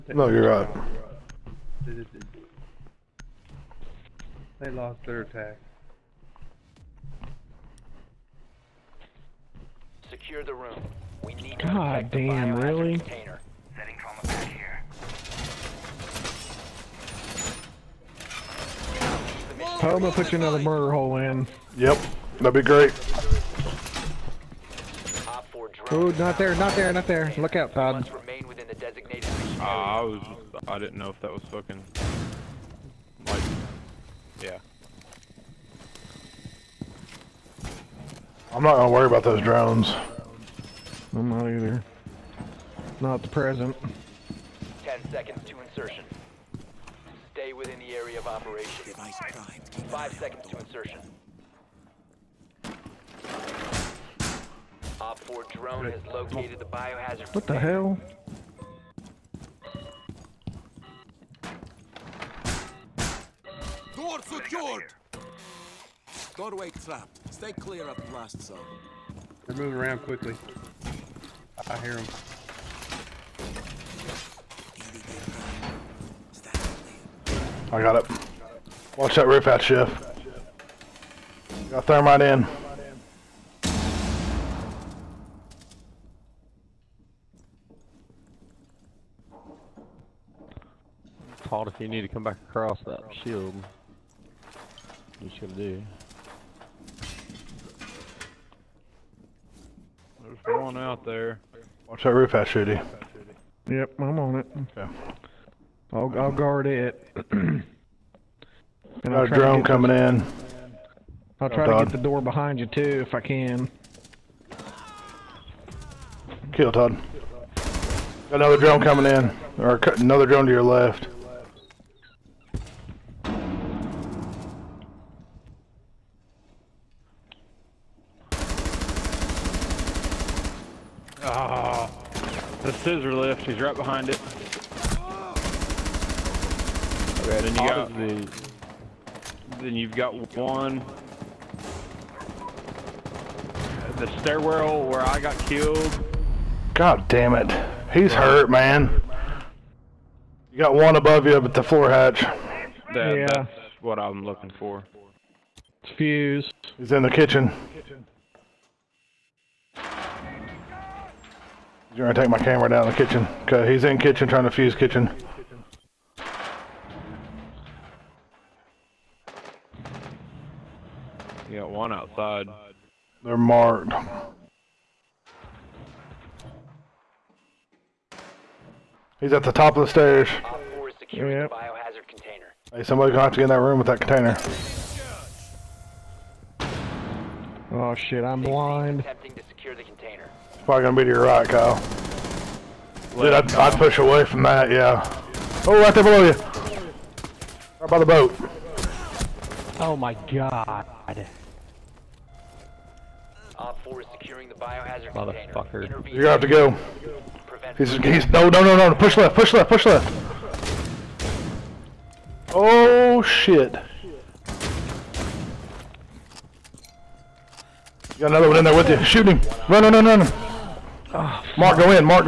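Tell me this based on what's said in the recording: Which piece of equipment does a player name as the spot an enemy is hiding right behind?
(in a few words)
Scissor lift.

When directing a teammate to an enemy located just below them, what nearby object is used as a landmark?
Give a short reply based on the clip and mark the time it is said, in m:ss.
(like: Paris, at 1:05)
The boat, at 3:17.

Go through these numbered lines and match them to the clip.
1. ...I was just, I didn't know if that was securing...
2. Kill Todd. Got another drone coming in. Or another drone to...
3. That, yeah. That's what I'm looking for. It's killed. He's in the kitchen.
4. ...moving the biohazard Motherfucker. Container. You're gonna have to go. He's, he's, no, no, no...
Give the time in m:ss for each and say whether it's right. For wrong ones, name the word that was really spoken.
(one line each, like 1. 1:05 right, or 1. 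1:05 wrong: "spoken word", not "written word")
1. 0:29 wrong: "fucking", not "securing"
2. 1:56 right
3. 2:32 wrong: "fused", not "killed"
4. 3:24 wrong: "securing", not "moving".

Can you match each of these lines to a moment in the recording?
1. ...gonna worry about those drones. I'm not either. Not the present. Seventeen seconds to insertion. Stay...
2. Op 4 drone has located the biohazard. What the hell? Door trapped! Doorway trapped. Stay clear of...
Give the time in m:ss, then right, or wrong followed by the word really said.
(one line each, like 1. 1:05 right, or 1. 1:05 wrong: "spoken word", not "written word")
1. 0:38 wrong: "Ten", not "Seventeen"
2. 0:54 wrong: "secured", not "trapped".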